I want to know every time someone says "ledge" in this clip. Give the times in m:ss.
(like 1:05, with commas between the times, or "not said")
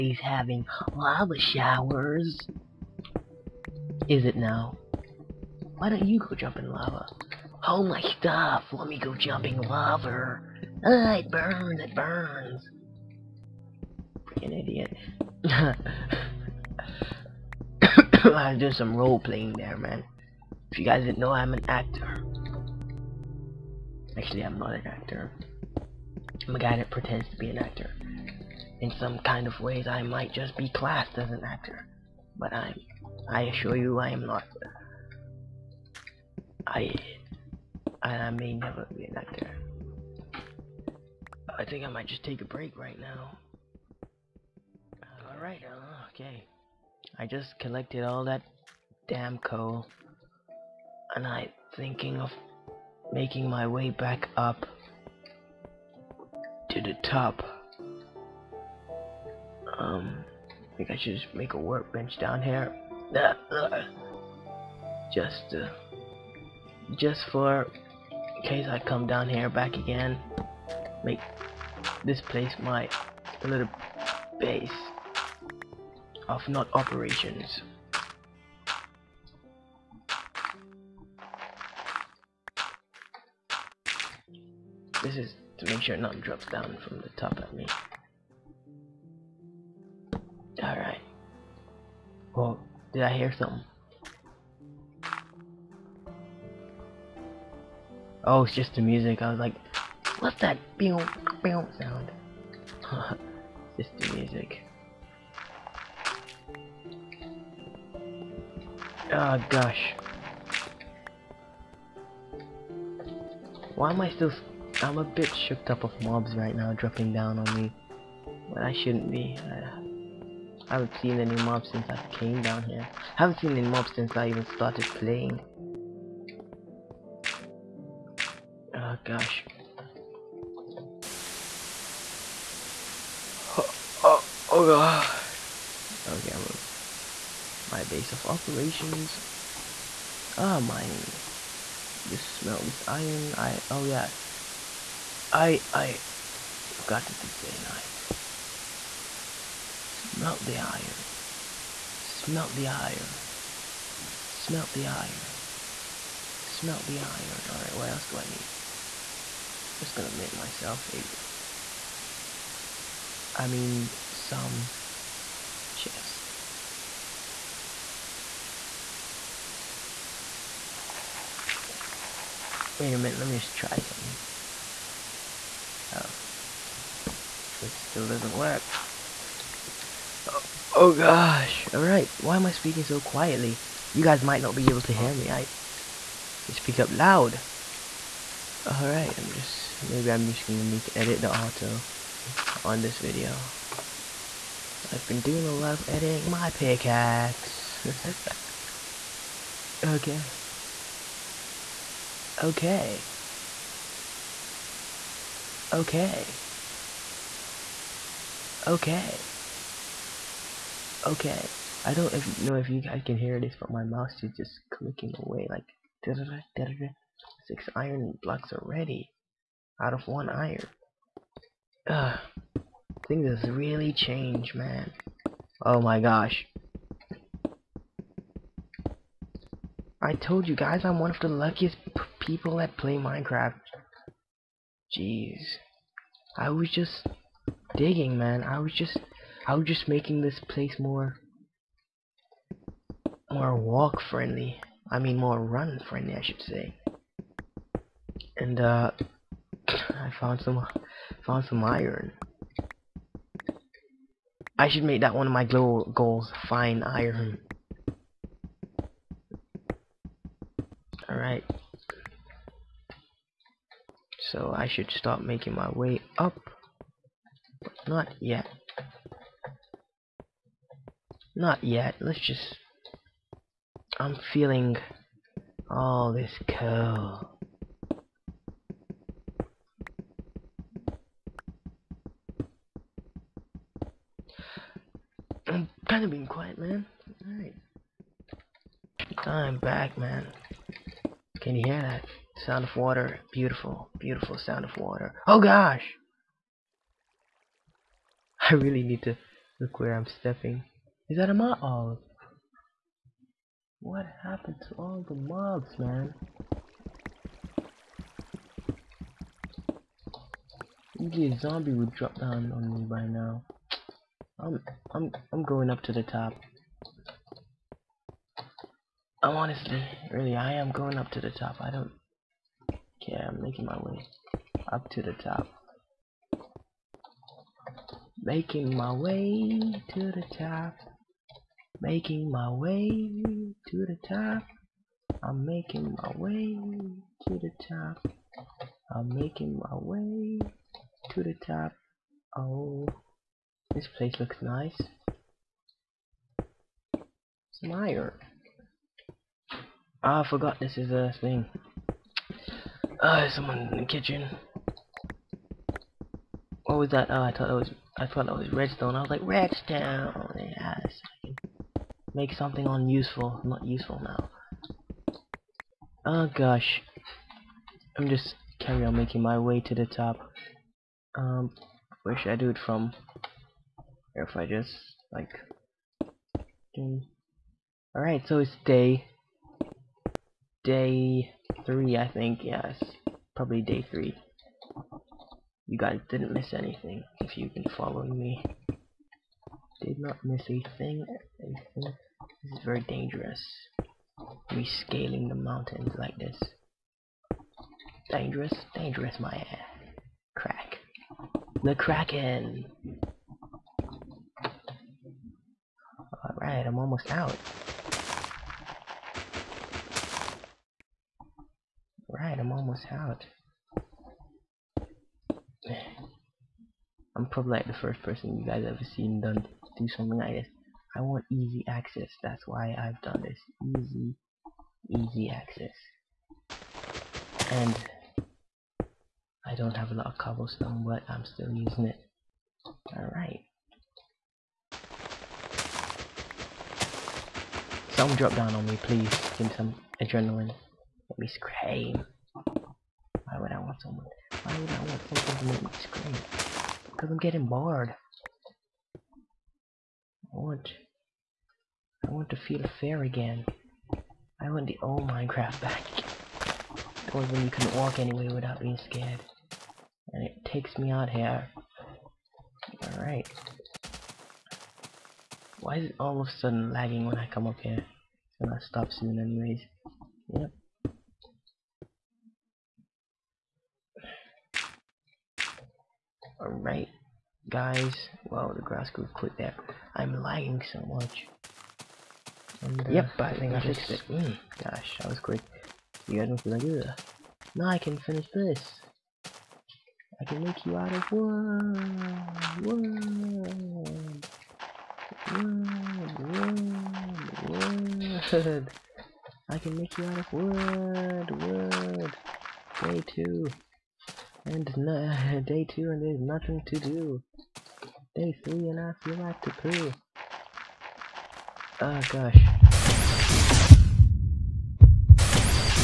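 not said.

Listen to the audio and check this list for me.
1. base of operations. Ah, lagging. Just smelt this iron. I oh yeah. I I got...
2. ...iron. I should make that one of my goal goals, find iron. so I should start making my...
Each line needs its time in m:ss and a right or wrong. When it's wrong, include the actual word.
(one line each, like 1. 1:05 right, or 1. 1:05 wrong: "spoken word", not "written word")
1. 2:17 wrong: "mining", not "lagging"
2. 4:11 right.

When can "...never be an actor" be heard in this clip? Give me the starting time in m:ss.
0:38.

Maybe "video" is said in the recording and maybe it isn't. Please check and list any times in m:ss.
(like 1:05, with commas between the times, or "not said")
3:12.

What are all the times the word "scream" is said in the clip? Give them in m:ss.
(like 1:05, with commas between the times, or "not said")
7:21, 7:25.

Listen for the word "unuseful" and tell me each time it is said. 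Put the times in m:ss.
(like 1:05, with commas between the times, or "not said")
6:02.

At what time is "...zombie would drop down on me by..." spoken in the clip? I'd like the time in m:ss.
5:11.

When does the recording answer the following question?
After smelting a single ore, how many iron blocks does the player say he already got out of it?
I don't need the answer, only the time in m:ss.
3:37.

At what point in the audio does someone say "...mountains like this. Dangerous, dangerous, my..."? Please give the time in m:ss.
6:35.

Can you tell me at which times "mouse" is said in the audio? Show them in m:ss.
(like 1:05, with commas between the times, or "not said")
3:33.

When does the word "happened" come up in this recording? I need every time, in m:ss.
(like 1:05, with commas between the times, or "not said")
5:04.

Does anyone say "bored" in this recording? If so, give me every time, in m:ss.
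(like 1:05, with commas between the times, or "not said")
7:27.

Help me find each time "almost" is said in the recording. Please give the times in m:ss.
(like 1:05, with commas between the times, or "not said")
6:46, 6:52.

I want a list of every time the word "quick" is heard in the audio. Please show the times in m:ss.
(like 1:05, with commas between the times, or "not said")
7:59, 8:05.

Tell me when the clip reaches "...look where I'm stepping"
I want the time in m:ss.
4:59.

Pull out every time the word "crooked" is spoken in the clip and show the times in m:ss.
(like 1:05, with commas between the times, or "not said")
not said.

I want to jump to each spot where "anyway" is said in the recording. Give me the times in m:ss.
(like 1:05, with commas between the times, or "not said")
7:37, 7:49.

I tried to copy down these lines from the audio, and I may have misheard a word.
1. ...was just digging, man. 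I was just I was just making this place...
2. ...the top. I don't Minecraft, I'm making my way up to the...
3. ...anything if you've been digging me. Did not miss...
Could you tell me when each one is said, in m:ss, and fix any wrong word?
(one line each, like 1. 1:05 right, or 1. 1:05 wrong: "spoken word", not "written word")
1. 3:56 right
2. 5:21 wrong: "Okay", not "Minecraft"
3. 6:26 wrong: "following", not "digging".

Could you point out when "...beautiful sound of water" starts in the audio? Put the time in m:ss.
4:53.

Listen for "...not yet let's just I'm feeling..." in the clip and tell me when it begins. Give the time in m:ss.
4:31.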